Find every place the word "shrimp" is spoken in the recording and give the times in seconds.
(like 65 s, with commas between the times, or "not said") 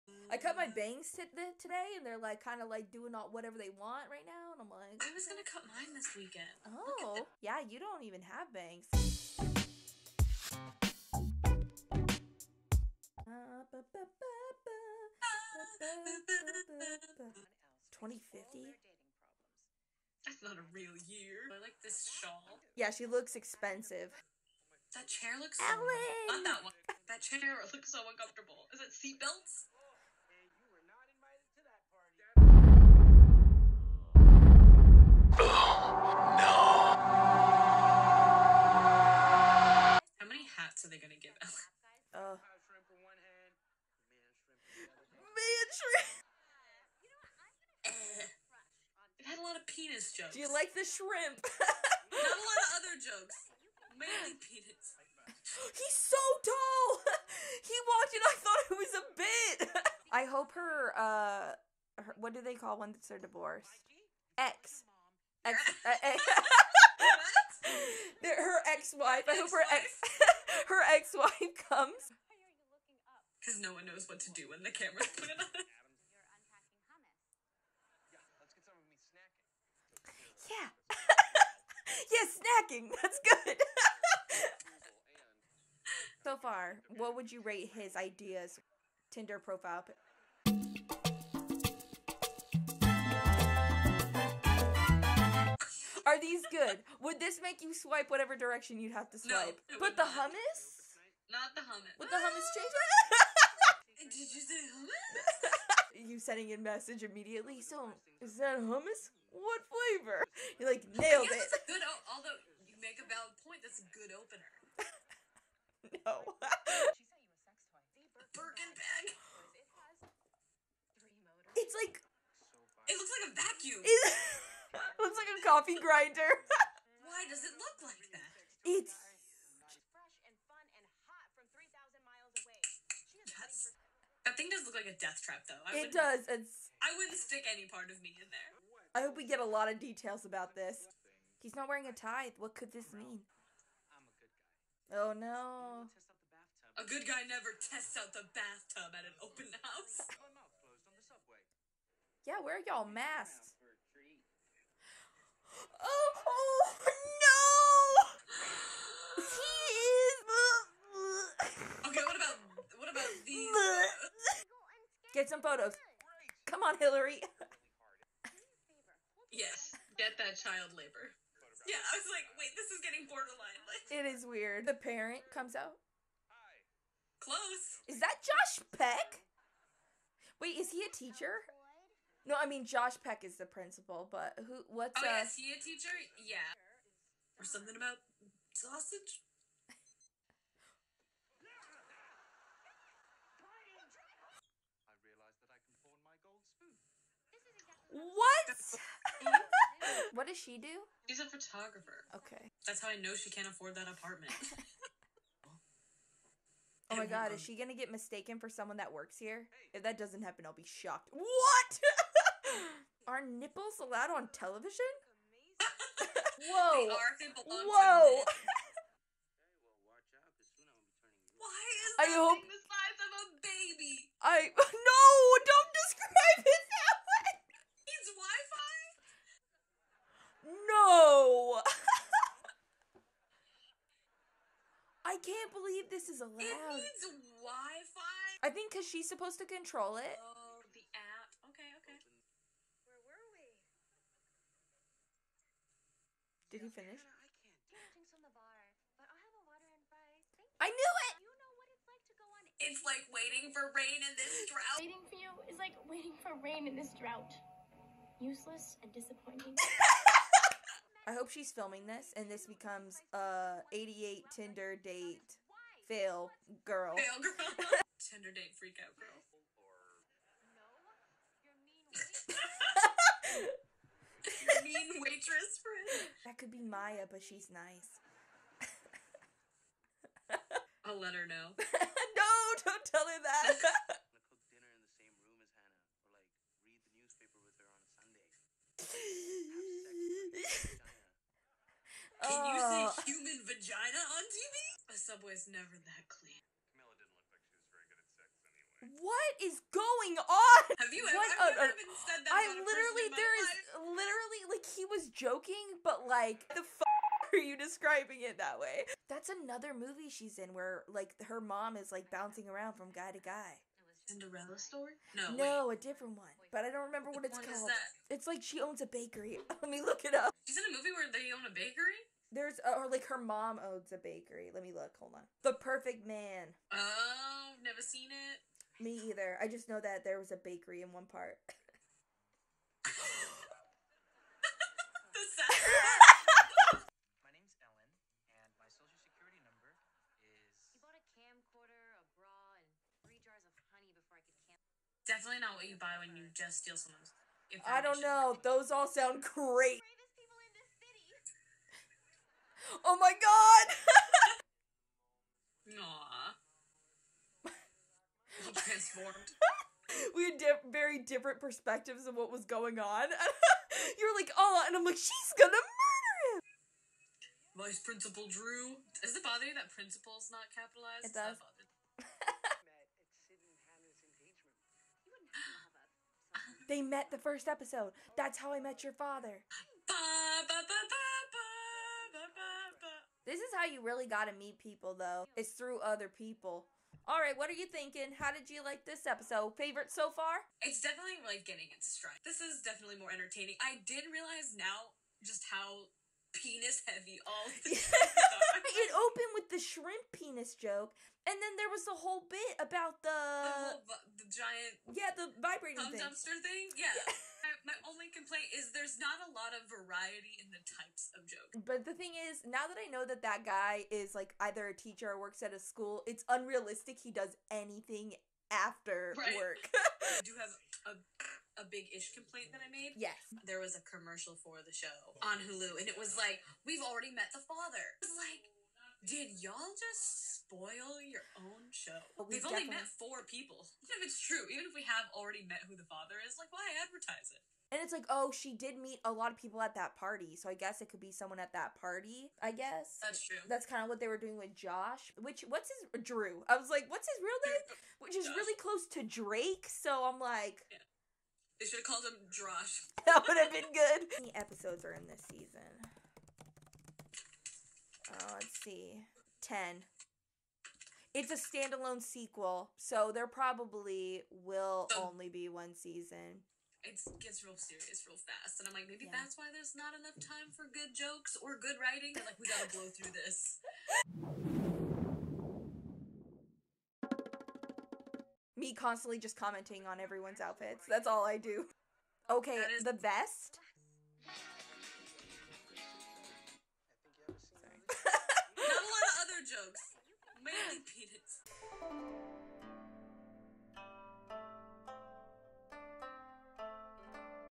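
50 s, 399 s.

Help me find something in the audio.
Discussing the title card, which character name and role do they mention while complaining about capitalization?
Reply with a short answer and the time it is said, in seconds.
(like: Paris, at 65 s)
Vice Principal Drew, at 367 s.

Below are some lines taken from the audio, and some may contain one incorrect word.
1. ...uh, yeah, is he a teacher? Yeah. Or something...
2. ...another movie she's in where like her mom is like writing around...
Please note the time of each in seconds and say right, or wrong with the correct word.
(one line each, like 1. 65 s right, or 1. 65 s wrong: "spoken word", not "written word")
1. 185 s right
2. 309 s wrong: "bouncing", not "writing".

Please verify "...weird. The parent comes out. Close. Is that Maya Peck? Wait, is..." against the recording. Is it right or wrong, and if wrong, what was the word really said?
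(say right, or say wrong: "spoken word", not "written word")
wrong: "Josh", not "Maya".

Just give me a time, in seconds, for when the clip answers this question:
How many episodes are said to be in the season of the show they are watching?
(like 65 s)
459 s.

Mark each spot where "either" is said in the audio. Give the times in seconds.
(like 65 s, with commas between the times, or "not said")
329 s, 414 s.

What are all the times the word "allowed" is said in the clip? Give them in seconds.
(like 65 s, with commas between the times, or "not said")
213 s, 236 s.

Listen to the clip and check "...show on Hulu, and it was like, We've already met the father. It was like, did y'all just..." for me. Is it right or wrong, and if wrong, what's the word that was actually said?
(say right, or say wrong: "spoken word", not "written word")
right.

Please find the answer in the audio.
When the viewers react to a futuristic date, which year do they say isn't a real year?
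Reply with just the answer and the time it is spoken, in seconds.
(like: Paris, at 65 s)
2050, at 17 s.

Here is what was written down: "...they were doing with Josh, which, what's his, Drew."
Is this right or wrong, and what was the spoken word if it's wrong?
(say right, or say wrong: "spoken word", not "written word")
right.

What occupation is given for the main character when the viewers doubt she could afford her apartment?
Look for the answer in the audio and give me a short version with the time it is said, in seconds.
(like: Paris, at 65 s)
Photographer, at 201 s.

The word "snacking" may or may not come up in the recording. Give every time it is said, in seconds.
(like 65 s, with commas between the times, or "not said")
82 s.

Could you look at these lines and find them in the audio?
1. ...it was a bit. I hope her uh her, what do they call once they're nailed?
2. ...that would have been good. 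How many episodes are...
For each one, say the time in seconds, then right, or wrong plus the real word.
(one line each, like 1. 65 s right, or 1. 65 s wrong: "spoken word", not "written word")
1. 58 s wrong: "divorced", not "nailed"
2. 453 s right.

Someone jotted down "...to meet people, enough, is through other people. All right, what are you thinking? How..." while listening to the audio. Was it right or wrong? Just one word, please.
wrong.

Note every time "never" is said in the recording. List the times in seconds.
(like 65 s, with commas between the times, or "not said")
147 s, 295 s, 327 s.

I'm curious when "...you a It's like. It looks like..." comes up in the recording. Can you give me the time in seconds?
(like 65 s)
119 s.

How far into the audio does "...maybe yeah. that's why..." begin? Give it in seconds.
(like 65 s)
468 s.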